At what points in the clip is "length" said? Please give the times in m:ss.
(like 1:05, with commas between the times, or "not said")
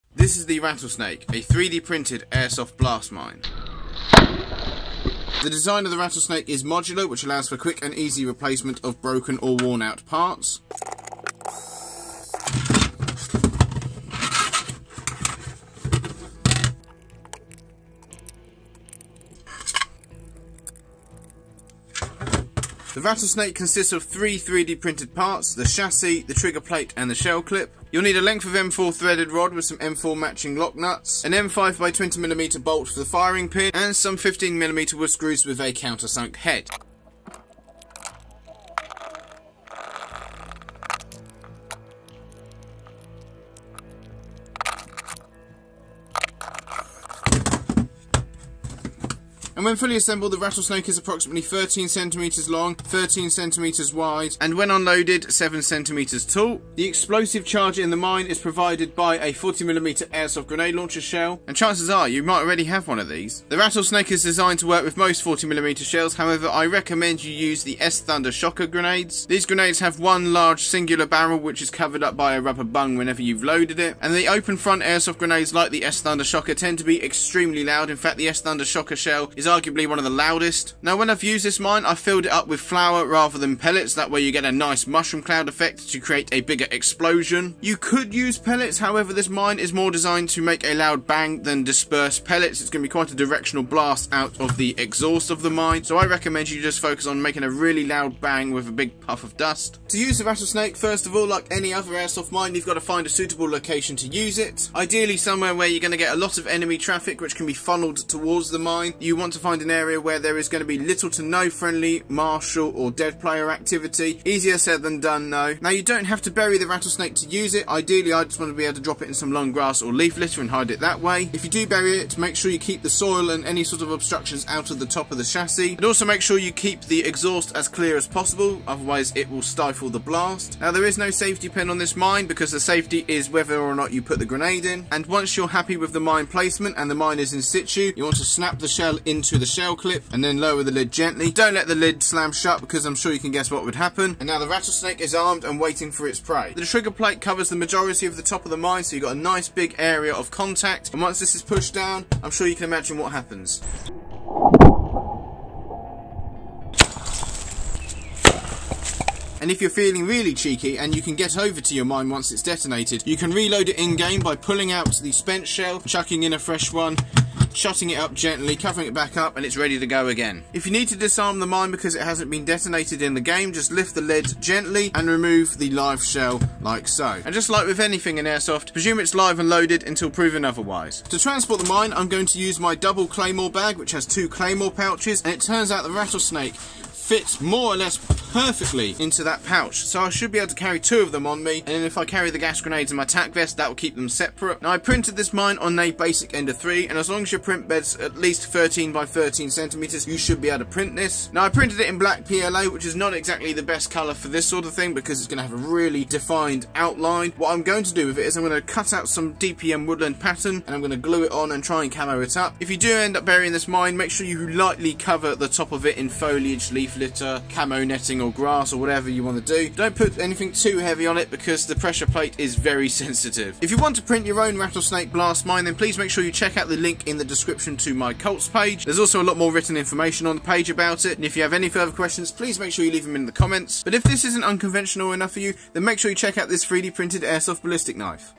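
0:28.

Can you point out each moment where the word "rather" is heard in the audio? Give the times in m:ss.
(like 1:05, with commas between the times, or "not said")
1:23.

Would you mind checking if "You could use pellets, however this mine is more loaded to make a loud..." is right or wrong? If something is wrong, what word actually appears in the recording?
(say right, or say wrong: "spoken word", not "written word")
wrong: "designed", not "loaded".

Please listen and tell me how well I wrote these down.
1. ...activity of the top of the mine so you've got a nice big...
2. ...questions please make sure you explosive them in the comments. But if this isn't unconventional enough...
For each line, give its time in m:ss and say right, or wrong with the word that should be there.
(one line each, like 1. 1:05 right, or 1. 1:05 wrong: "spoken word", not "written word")
1. 2:27 wrong: "majority", not "activity"
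2. 3:51 wrong: "leave", not "explosive".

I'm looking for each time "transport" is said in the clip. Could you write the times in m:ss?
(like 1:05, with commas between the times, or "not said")
3:01.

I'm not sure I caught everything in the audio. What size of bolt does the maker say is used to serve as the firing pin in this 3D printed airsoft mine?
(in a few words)
M5 by 20mm.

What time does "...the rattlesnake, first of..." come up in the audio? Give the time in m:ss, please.
1:40.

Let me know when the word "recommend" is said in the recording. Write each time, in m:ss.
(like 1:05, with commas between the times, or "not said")
1:06, 1:36.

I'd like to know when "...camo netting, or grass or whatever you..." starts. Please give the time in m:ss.
3:37.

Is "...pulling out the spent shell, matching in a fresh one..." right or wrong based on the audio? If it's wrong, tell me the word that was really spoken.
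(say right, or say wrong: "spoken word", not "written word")
wrong: "chucking", not "matching".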